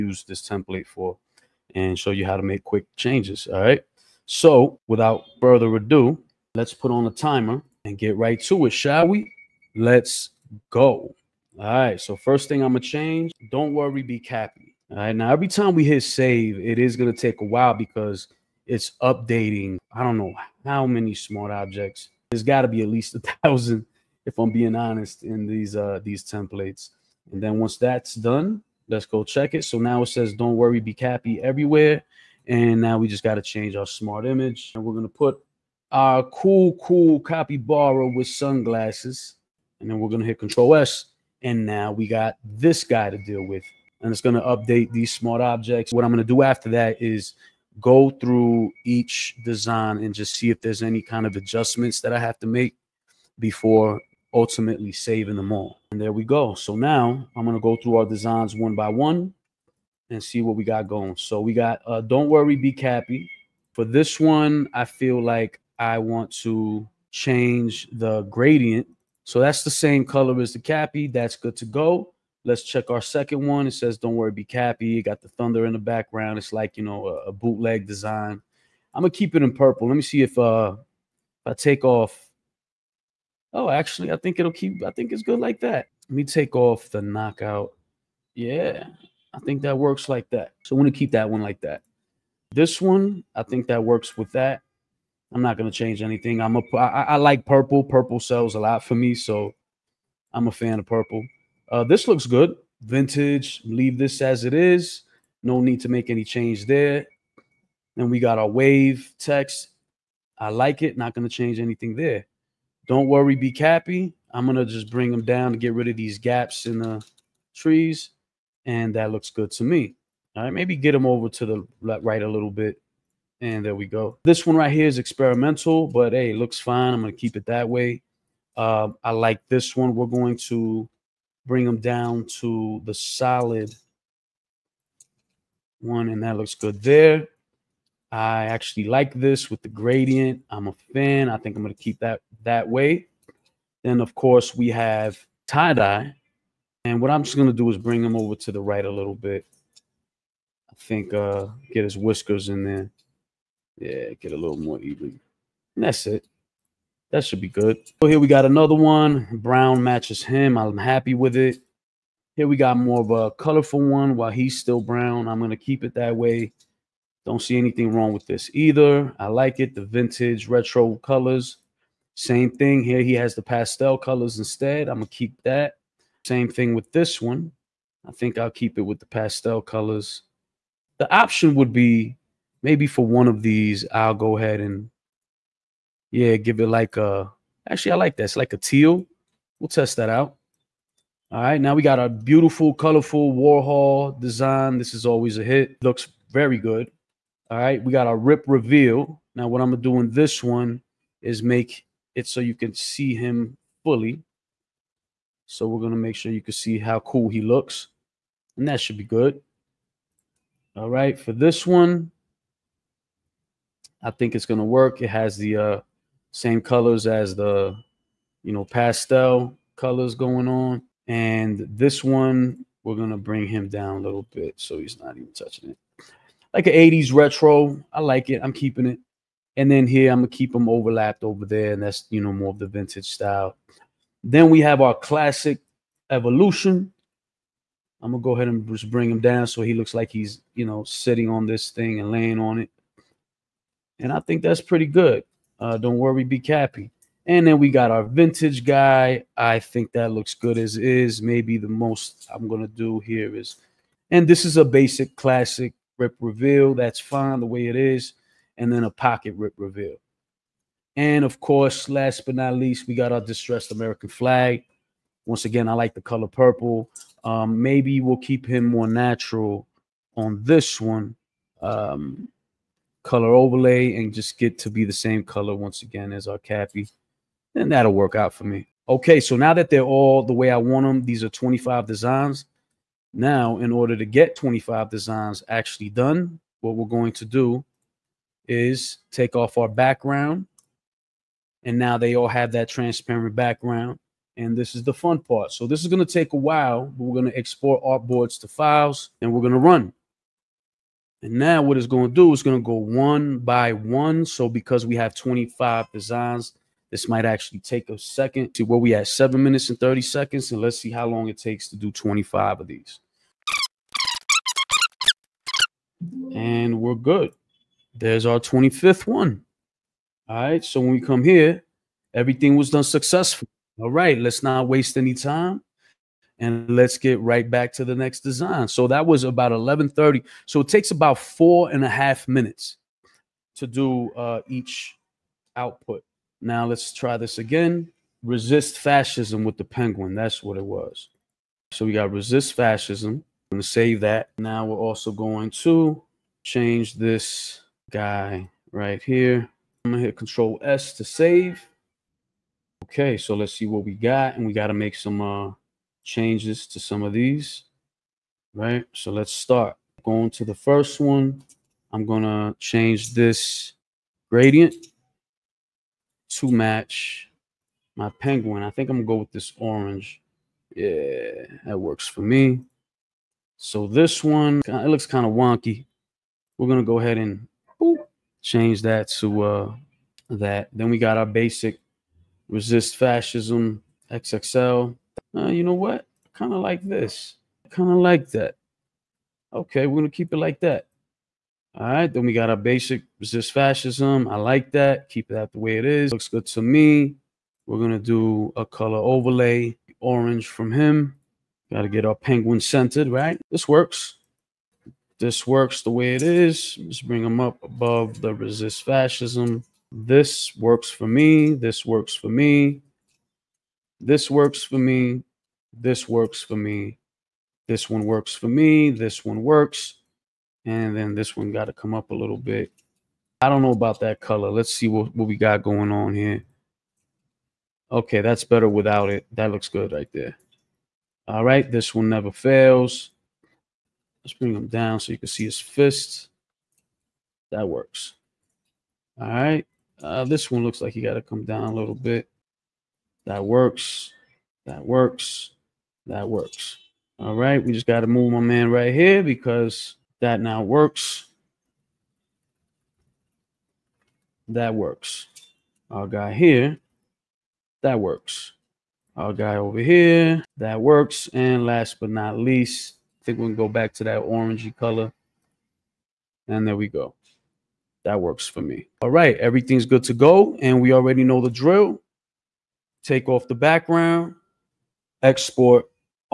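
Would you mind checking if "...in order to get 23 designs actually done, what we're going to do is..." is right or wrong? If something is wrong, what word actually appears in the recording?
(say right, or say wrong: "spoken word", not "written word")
wrong: "25", not "23".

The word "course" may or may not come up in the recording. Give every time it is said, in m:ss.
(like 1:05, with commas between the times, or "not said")
2:24, 4:21.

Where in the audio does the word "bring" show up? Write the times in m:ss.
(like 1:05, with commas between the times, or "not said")
1:54, 2:11, 2:27, 3:43, 3:58, 6:47, 7:14.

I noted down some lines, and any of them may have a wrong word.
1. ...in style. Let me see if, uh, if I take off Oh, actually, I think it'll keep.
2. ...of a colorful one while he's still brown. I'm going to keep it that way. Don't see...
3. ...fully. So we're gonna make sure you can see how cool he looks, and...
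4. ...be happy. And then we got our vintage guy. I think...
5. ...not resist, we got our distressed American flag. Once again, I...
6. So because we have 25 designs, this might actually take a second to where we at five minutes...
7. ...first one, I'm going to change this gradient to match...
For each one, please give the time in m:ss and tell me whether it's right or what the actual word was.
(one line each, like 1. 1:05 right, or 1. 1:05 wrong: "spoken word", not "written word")
1. 1:19 wrong: "purple", not "style"
2. 2:43 right
3. 3:23 right
4. 4:06 right
5. 4:22 wrong: "least", not "resist"
6. 5:04 wrong: "seven", not "five"
7. 6:00 right.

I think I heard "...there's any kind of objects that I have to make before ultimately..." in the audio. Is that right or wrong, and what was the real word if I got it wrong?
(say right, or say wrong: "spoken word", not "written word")
wrong: "adjustments", not "objects".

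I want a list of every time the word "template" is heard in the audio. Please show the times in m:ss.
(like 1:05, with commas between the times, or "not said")
0:00, 0:26.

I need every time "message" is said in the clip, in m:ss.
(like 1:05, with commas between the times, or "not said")
not said.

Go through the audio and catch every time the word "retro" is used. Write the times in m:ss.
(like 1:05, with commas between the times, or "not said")
2:50, 3:47.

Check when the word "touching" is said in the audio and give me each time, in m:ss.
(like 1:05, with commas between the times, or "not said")
3:45.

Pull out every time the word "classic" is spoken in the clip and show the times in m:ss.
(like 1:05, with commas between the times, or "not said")
3:54, 4:15.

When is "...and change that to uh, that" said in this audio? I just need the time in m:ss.
6:17.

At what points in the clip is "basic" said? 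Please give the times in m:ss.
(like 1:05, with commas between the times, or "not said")
4:14, 6:21, 6:32.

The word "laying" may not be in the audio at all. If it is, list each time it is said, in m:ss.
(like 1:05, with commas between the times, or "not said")
4:02.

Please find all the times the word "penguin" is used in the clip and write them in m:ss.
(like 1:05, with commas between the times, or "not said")
5:39, 6:08, 6:42.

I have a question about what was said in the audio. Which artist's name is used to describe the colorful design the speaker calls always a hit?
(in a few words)
Warhol.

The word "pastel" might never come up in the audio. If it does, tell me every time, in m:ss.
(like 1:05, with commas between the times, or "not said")
2:53, 2:59, 3:38.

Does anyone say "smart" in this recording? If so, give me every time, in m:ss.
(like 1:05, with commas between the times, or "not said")
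0:21, 0:33, 0:45.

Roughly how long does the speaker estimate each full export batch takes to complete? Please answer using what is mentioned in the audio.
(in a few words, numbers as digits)
4 and a half minutes.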